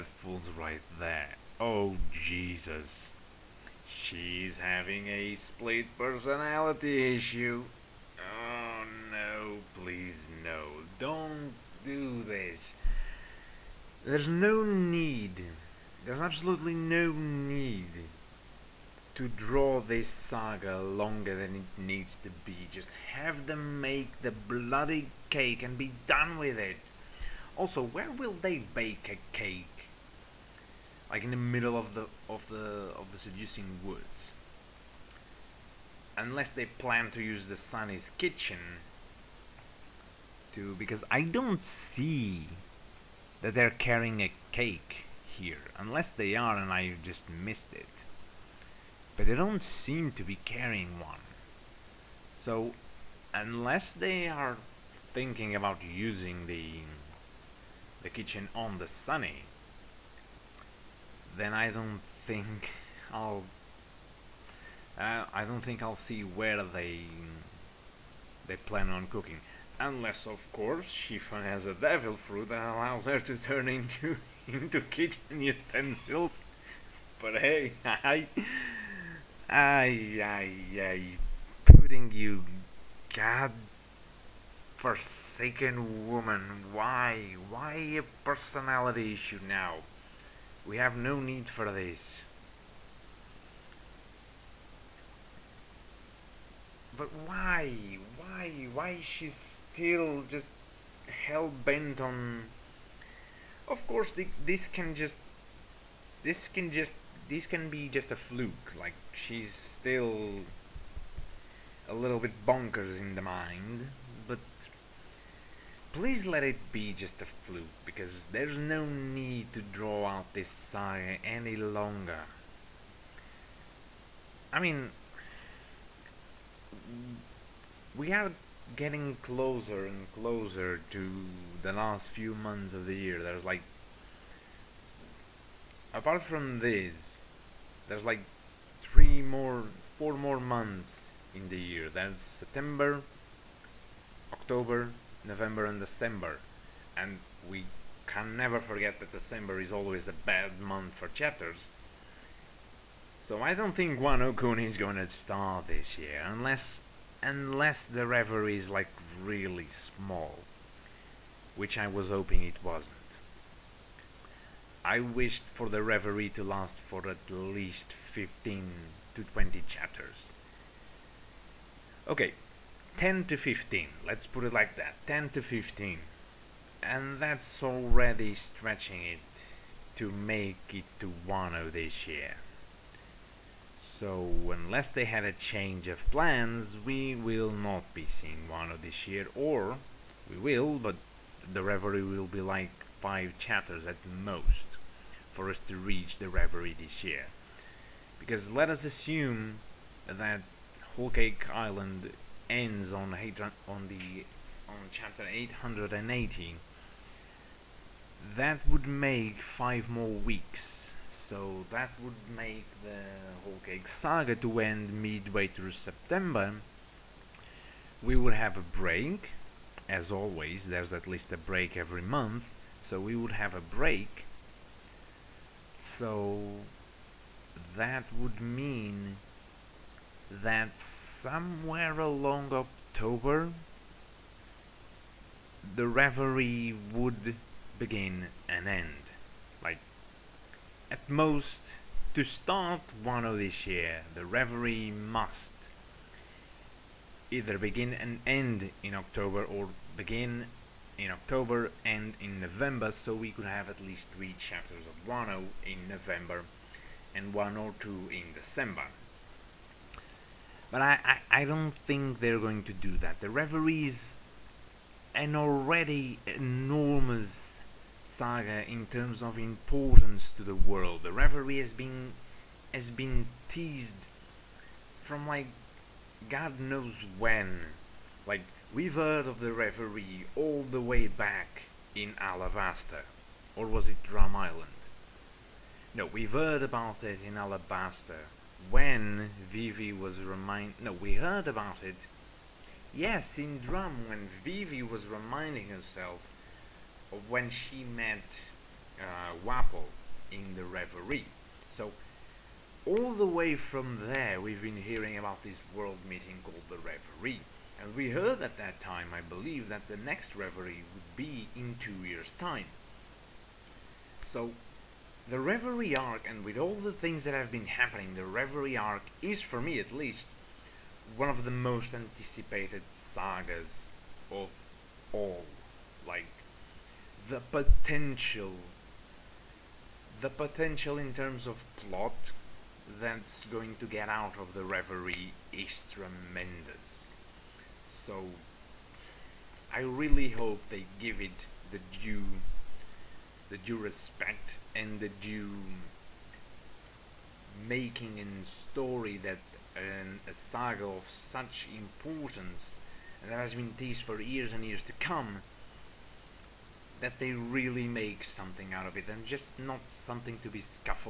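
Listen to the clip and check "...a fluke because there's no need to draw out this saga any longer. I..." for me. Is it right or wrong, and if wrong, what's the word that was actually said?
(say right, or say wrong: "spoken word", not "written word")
right.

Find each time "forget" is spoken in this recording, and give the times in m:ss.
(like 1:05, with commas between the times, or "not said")
2:28.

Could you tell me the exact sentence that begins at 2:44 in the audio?
I wished for the reverie to last for at least 15 to 20 chapters.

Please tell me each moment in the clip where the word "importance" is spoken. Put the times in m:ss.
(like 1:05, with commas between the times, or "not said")
4:29, 5:51.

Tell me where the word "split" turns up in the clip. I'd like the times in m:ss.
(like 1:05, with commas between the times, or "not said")
0:05.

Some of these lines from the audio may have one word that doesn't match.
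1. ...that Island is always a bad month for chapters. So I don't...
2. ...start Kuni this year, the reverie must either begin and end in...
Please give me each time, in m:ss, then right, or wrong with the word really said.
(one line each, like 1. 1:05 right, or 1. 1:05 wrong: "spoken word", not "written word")
1. 2:29 wrong: "December", not "Island"
2. 4:02 wrong: "Wano", not "Kuni".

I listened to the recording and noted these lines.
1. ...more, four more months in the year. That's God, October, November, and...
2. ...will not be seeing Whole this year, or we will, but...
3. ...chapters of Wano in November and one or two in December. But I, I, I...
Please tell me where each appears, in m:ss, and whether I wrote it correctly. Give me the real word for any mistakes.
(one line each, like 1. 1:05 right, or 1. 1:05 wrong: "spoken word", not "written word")
1. 2:19 wrong: "September", not "God"
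2. 3:07 wrong: "Wano", not "Whole"
3. 4:14 right.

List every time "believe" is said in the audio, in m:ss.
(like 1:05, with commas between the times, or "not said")
5:09.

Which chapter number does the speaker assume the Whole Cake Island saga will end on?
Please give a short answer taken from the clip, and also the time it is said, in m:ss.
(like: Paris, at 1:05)
880, at 3:25.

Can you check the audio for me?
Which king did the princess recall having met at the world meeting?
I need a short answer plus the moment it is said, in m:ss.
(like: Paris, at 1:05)
Wapol, at 4:59.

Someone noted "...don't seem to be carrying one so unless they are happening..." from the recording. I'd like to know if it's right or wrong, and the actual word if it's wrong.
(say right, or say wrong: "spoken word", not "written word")
wrong: "thinking", not "happening".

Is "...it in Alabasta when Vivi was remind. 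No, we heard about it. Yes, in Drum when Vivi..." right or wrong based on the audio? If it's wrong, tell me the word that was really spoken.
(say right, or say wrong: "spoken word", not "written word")
right.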